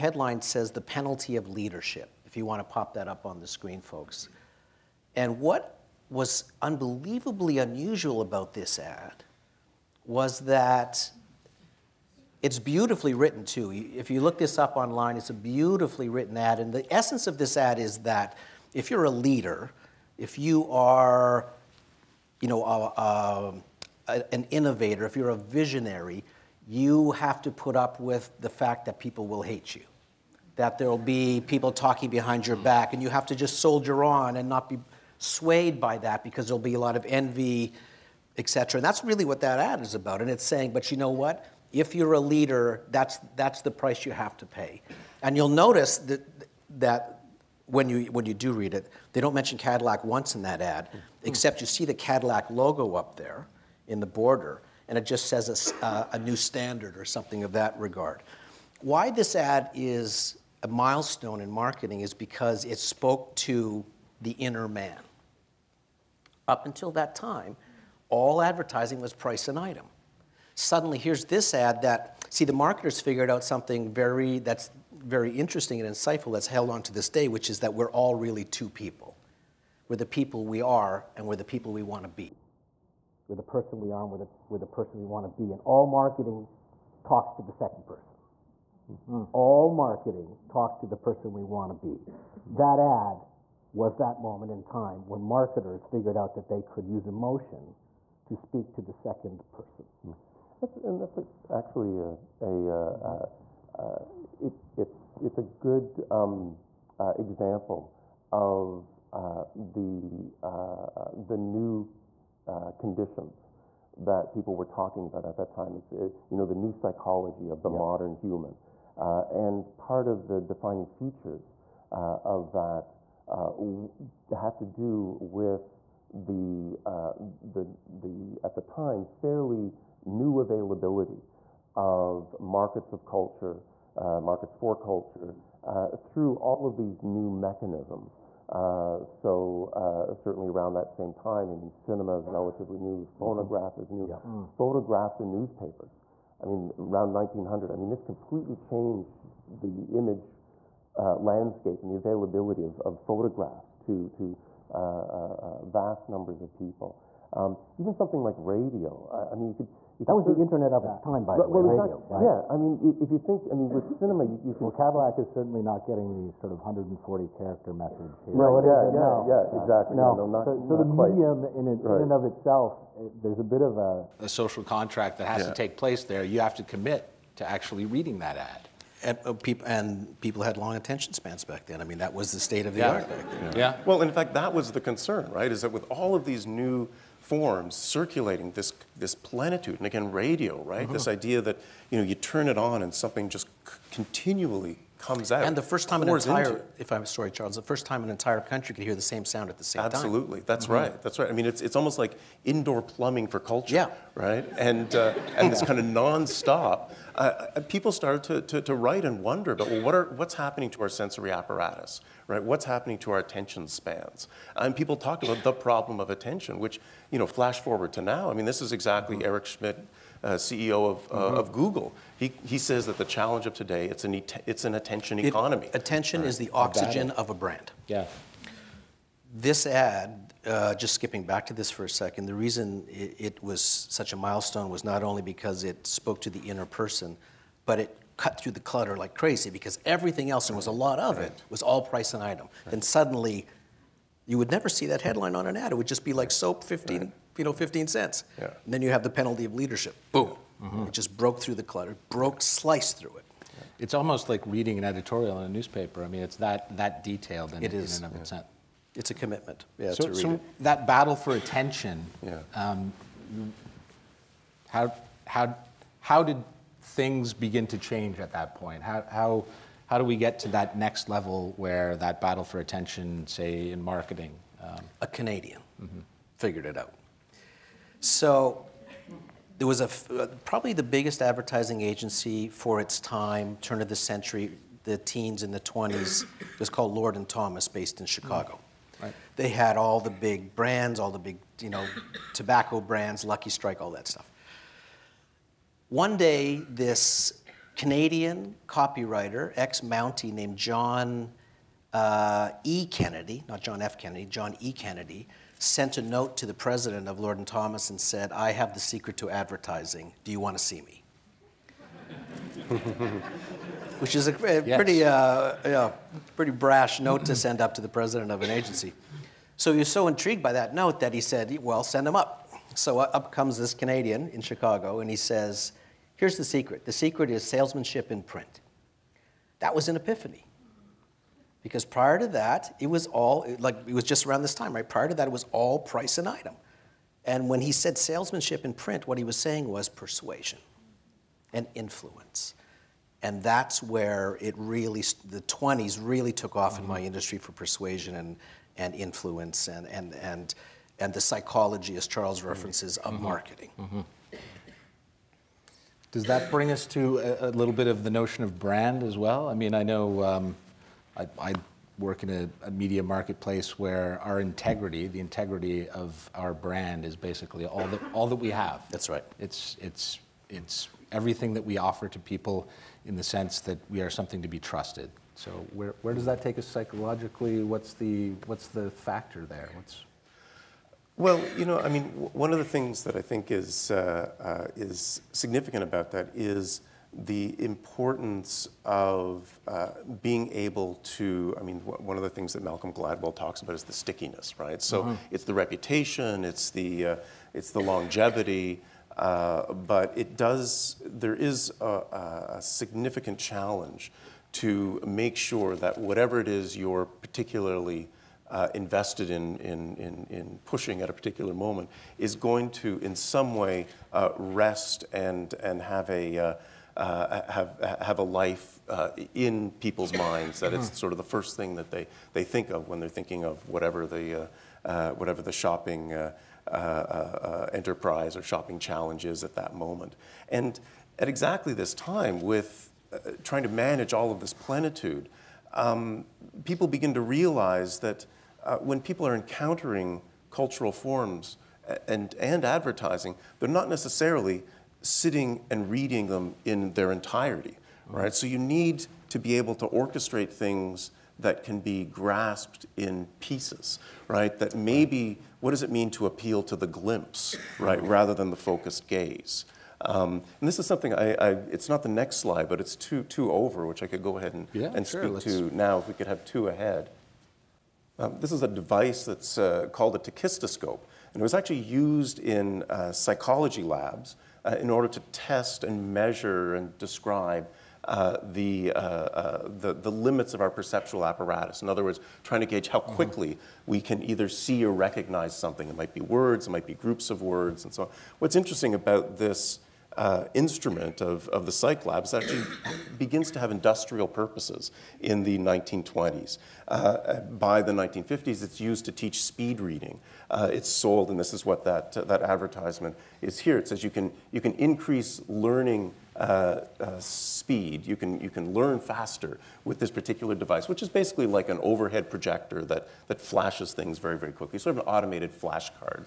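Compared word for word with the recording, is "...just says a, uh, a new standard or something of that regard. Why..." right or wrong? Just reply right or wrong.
right.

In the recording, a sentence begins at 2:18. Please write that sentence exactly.
Uh, so uh, certainly around that same time, I mean, cinema is relatively new, the mm-hmm.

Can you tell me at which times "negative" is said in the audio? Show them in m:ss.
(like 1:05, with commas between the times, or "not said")
not said.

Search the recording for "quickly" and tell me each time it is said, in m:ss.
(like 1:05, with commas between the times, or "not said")
8:03, 8:34.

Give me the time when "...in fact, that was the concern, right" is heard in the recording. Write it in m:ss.
3:04.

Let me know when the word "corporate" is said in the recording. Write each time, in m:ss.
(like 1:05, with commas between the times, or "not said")
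not said.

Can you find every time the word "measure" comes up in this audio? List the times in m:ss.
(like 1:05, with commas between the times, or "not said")
7:56.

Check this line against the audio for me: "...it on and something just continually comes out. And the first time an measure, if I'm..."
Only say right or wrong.
wrong.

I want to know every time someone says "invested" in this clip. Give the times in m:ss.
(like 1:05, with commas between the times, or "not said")
6:48.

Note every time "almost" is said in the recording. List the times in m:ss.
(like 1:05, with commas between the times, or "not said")
3:21, 4:13.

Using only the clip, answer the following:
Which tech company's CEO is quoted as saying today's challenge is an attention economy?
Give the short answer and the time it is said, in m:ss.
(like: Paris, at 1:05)
Google, at 3:41.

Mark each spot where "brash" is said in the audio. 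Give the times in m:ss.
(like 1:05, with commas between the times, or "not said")
5:16.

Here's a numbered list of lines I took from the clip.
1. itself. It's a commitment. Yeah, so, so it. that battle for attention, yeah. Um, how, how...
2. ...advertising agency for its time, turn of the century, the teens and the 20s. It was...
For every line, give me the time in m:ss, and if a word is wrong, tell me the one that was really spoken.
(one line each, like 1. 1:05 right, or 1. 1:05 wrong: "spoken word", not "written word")
1. 4:18 right
2. 4:41 right.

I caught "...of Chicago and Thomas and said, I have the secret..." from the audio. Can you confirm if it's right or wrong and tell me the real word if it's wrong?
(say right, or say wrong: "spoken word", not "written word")
wrong: "Lord", not "Chicago".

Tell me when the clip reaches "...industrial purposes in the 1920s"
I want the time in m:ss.
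8:13.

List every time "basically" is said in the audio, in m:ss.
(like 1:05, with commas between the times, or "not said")
6:07, 8:31.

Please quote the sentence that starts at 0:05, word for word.
And what was unbelievably unusual about this ad was that it's beautifully written, too.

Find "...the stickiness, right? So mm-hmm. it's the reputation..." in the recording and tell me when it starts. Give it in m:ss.
6:33.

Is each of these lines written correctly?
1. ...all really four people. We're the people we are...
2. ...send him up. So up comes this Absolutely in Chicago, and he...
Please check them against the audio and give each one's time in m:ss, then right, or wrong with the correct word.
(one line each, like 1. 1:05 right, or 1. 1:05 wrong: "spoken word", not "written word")
1. 1:17 wrong: "two", not "four"
2. 5:21 wrong: "Canadian", not "Absolutely".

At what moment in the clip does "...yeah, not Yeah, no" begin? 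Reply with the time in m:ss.
2:48.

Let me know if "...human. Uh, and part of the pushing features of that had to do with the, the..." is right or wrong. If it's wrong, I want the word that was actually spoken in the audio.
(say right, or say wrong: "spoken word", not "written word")
wrong: "defining", not "pushing".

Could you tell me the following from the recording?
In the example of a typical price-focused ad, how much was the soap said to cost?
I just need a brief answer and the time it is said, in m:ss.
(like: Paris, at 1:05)
15 cents, at 4:07.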